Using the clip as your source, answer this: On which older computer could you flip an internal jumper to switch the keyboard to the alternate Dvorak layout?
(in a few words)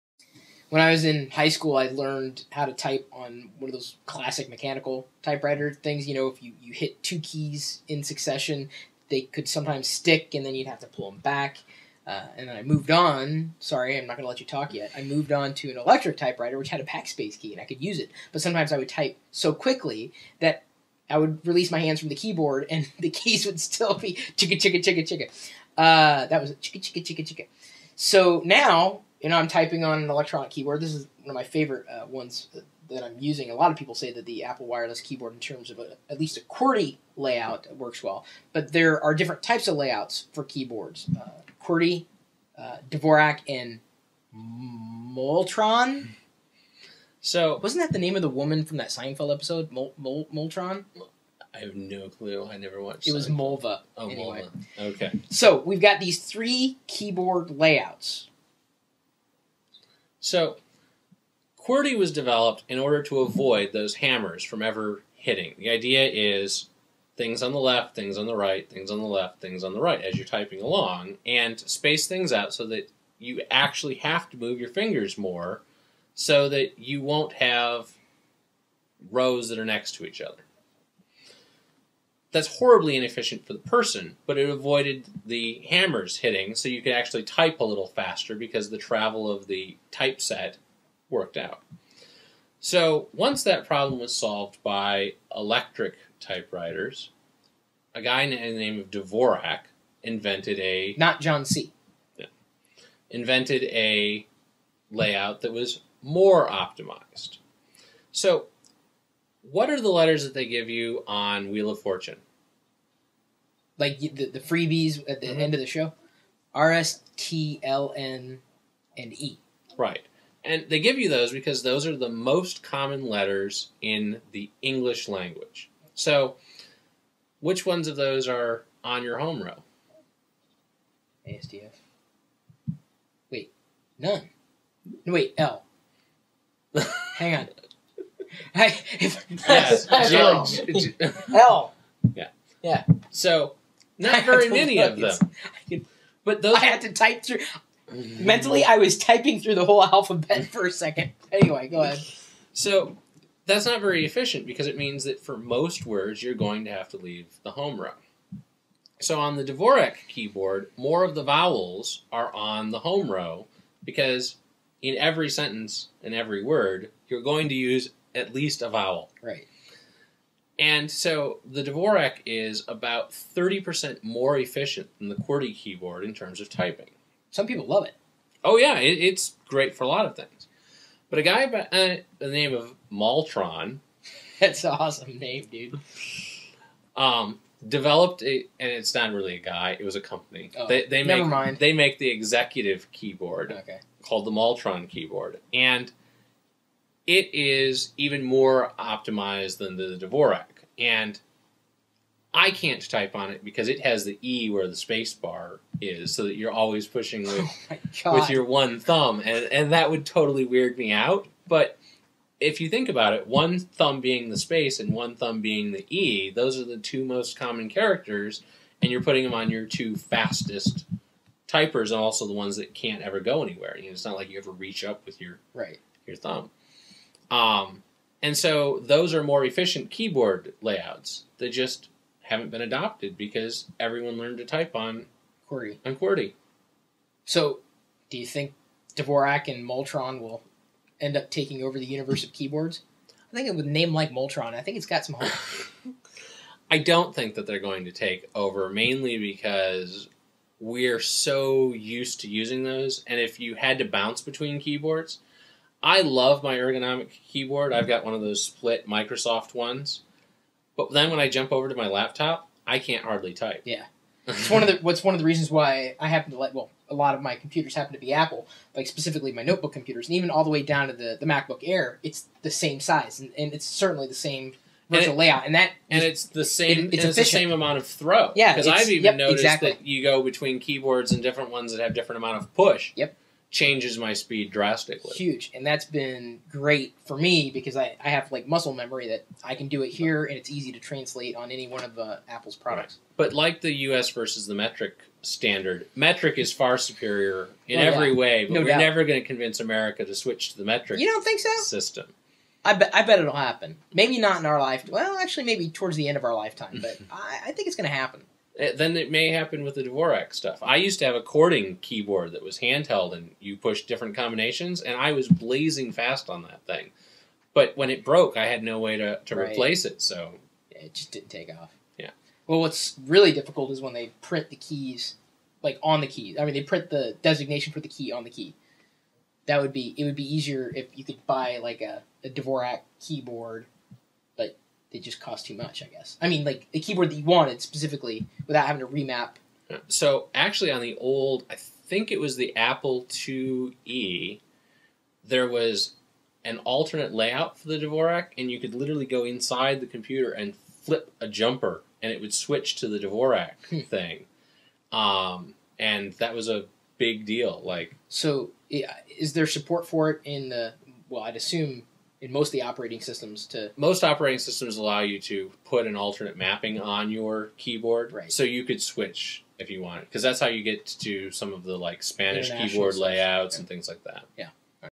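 Apple IIe.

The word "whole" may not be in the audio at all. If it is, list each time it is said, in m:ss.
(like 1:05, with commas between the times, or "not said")
2:29.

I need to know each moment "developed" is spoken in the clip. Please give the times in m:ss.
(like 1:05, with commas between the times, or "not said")
1:02, 3:07.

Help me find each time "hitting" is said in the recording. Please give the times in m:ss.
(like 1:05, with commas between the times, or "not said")
1:05, 1:26.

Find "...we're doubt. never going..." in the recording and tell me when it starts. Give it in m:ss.
4:58.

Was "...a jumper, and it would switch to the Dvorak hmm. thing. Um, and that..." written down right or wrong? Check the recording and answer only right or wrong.
right.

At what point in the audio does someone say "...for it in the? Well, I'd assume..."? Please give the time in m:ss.
5:59.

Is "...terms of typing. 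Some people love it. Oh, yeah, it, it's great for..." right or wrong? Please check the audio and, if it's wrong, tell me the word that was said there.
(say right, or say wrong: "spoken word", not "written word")
right.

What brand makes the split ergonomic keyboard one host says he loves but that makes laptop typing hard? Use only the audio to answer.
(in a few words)
Microsoft.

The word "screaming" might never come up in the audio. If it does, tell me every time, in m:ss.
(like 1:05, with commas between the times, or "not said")
not said.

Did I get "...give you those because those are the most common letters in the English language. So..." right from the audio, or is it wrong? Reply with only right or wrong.
right.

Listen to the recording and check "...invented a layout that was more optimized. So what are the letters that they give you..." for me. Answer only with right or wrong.
right.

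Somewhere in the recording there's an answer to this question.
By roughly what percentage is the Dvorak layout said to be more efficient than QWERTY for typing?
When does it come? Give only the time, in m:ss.
2:53.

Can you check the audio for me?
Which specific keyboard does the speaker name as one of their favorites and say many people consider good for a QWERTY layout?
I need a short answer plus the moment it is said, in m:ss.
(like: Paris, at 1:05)
Apple Wireless keyboard, at 0:34.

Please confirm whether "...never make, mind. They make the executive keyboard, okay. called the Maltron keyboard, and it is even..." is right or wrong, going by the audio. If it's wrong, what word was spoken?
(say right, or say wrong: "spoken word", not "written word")
right.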